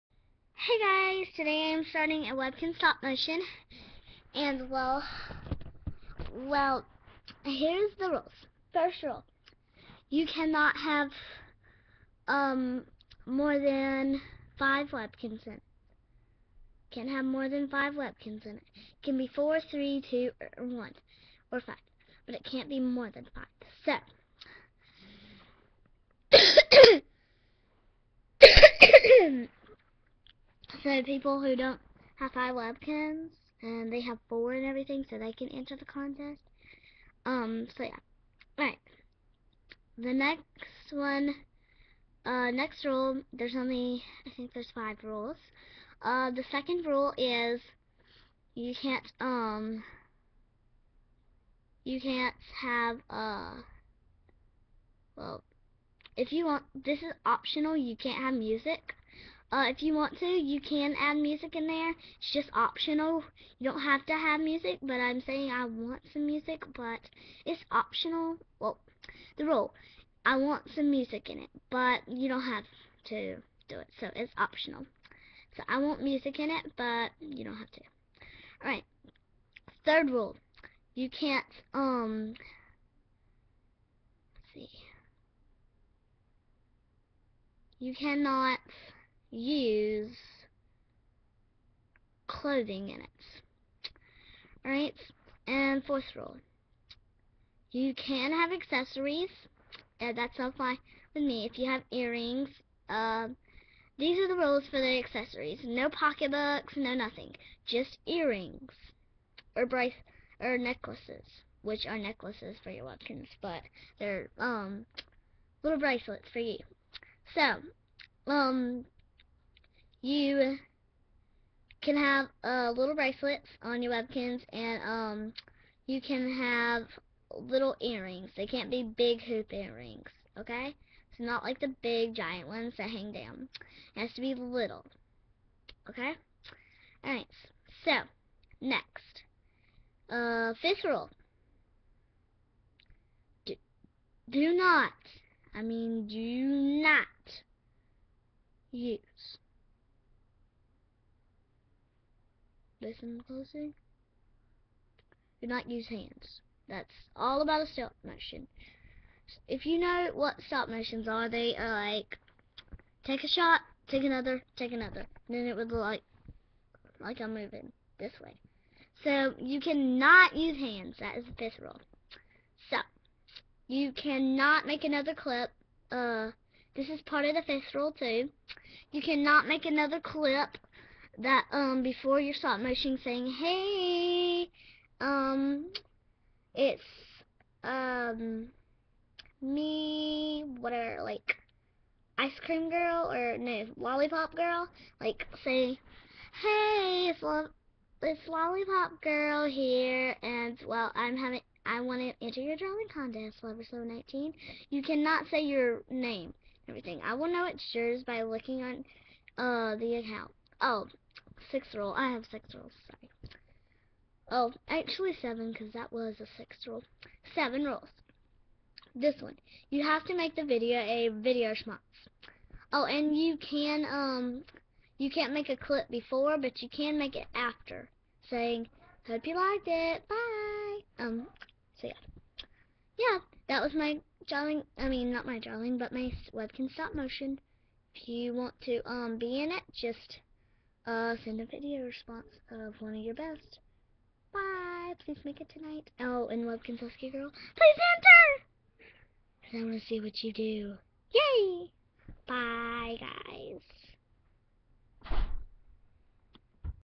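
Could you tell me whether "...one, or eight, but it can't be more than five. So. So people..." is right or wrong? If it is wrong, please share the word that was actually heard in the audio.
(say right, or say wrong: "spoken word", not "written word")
wrong: "five", not "eight".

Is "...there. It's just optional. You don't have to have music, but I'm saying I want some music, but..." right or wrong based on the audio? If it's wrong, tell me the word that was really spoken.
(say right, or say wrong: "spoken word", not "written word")
right.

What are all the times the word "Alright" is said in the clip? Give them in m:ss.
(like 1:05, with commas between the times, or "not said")
1:18, 1:34.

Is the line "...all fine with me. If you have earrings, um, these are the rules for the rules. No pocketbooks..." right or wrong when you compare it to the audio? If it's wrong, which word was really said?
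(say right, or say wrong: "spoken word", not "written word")
wrong: "accessories", not "rules".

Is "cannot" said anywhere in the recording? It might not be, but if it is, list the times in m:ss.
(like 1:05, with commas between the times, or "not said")
0:10, 1:27, 2:49, 2:53, 2:59, 3:24.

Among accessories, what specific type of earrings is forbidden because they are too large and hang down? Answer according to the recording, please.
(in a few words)
Big hoop earrings.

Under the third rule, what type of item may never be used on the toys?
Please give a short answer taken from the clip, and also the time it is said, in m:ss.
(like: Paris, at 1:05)
Clothing, at 1:32.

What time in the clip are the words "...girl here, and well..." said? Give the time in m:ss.
3:19.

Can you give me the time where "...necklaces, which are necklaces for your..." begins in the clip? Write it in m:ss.
1:50.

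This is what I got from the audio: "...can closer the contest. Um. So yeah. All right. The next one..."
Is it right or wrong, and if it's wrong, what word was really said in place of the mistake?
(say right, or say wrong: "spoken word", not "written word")
wrong: "enter", not "closer".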